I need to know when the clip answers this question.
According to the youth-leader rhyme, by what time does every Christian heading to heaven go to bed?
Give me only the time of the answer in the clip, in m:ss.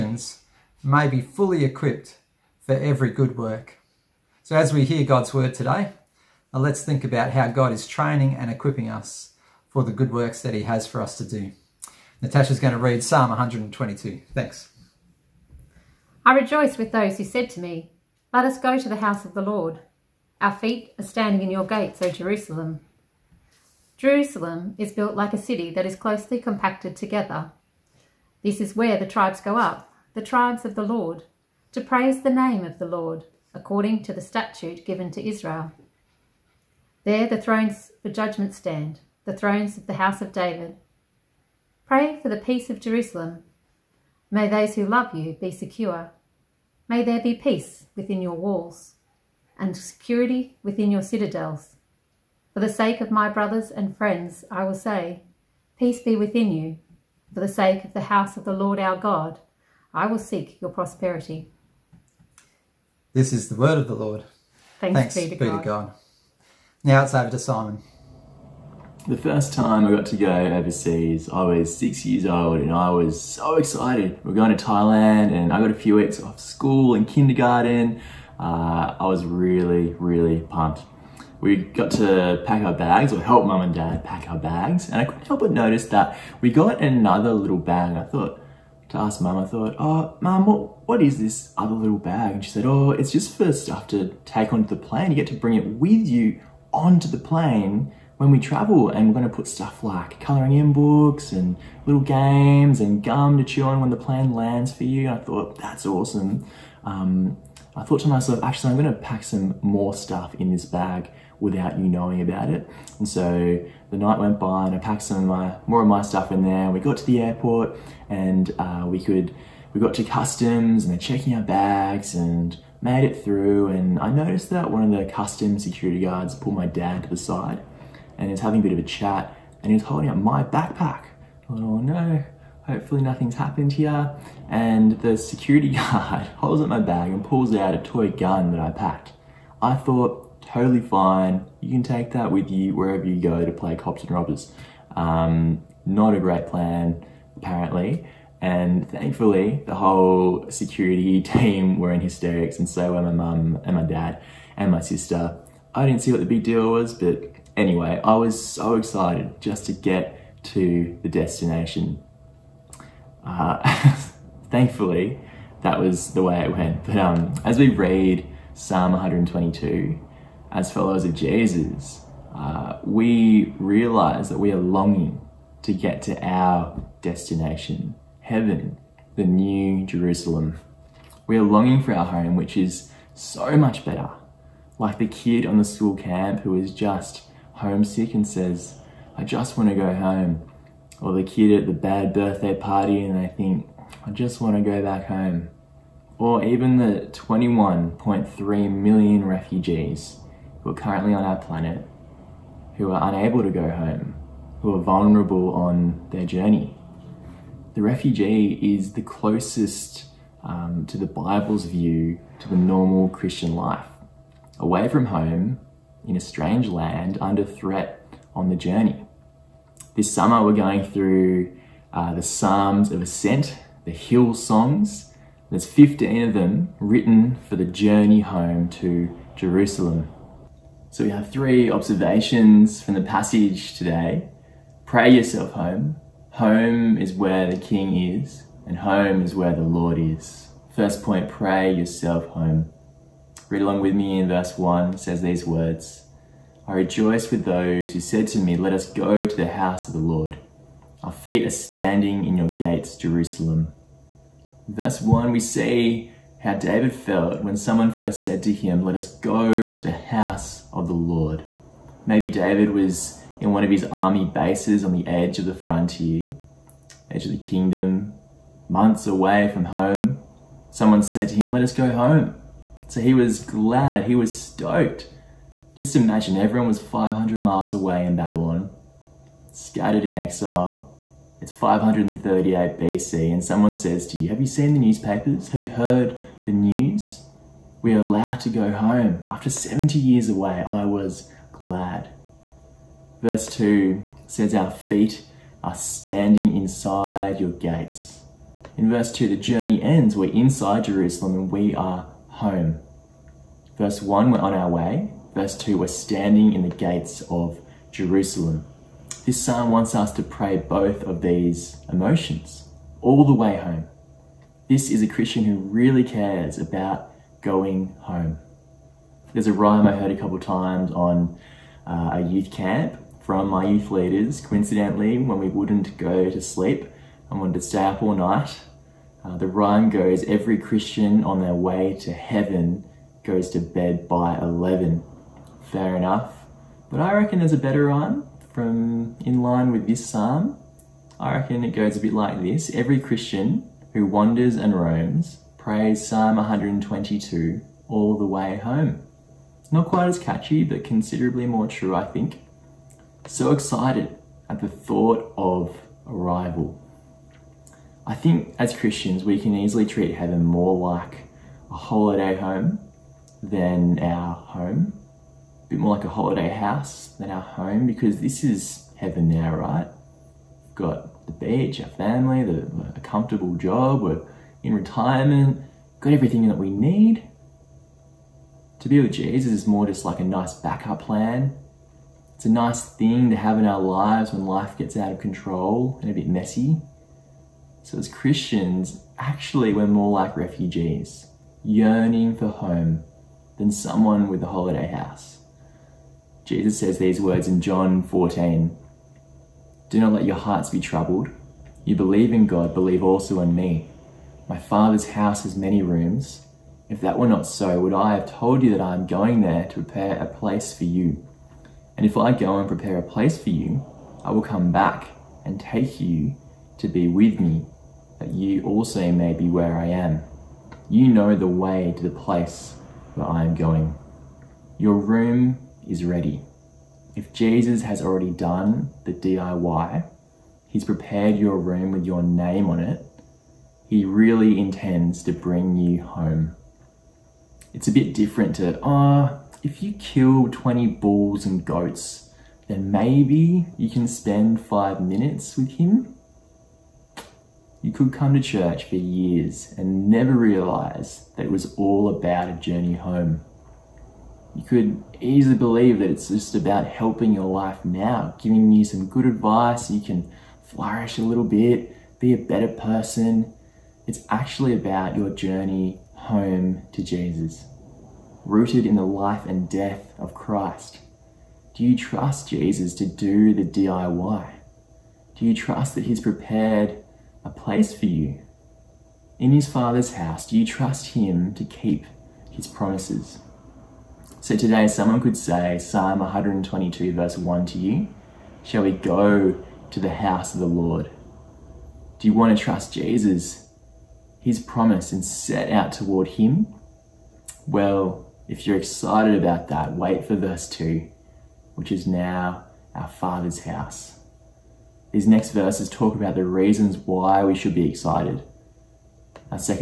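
5:34.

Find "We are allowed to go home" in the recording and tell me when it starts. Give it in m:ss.
4:47.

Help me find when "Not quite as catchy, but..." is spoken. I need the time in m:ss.
5:49.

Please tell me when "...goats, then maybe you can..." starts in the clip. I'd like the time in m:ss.
7:21.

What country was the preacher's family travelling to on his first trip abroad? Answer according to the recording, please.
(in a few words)
Thailand.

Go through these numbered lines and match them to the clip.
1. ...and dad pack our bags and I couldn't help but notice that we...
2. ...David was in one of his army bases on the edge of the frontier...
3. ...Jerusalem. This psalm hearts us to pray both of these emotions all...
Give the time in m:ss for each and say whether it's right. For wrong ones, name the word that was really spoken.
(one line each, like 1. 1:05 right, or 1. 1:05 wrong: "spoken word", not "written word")
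1. 1:23 right
2. 4:22 right
3. 5:07 wrong: "wants", not "hearts".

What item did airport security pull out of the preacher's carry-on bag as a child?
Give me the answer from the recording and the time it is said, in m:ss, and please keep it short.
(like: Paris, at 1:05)
A toy gun, at 2:17.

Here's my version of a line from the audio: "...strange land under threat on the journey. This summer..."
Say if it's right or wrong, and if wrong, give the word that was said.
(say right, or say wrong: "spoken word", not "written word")
right.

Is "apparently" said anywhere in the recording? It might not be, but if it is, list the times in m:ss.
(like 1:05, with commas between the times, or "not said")
2:27.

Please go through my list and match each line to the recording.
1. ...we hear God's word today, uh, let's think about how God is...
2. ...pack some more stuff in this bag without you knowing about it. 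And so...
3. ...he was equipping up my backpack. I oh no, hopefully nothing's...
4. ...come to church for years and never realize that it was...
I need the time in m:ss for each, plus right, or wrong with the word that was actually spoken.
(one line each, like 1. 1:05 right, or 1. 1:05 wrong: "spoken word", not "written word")
1. 0:04 right
2. 1:48 right
3. 2:09 wrong: "holding", not "equipping"
4. 7:28 right.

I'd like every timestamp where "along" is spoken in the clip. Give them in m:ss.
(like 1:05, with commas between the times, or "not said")
4:03.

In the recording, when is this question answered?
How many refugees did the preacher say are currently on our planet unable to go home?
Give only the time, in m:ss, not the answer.
3:17.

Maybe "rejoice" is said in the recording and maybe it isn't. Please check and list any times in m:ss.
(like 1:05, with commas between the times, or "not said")
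0:16, 4:06.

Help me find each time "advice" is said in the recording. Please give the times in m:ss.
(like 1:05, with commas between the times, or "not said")
7:39.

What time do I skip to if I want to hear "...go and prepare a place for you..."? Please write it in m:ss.
6:52.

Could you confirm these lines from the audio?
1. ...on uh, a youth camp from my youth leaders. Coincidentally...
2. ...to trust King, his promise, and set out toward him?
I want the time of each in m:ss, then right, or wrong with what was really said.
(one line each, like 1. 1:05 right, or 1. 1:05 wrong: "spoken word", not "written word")
1. 5:20 right
2. 8:12 wrong: "Jesus", not "King".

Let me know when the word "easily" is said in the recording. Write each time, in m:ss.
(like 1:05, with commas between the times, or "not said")
5:59, 7:35.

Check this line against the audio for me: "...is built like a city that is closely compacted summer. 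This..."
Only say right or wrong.
wrong.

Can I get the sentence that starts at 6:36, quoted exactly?
Jesus says these words in John 14.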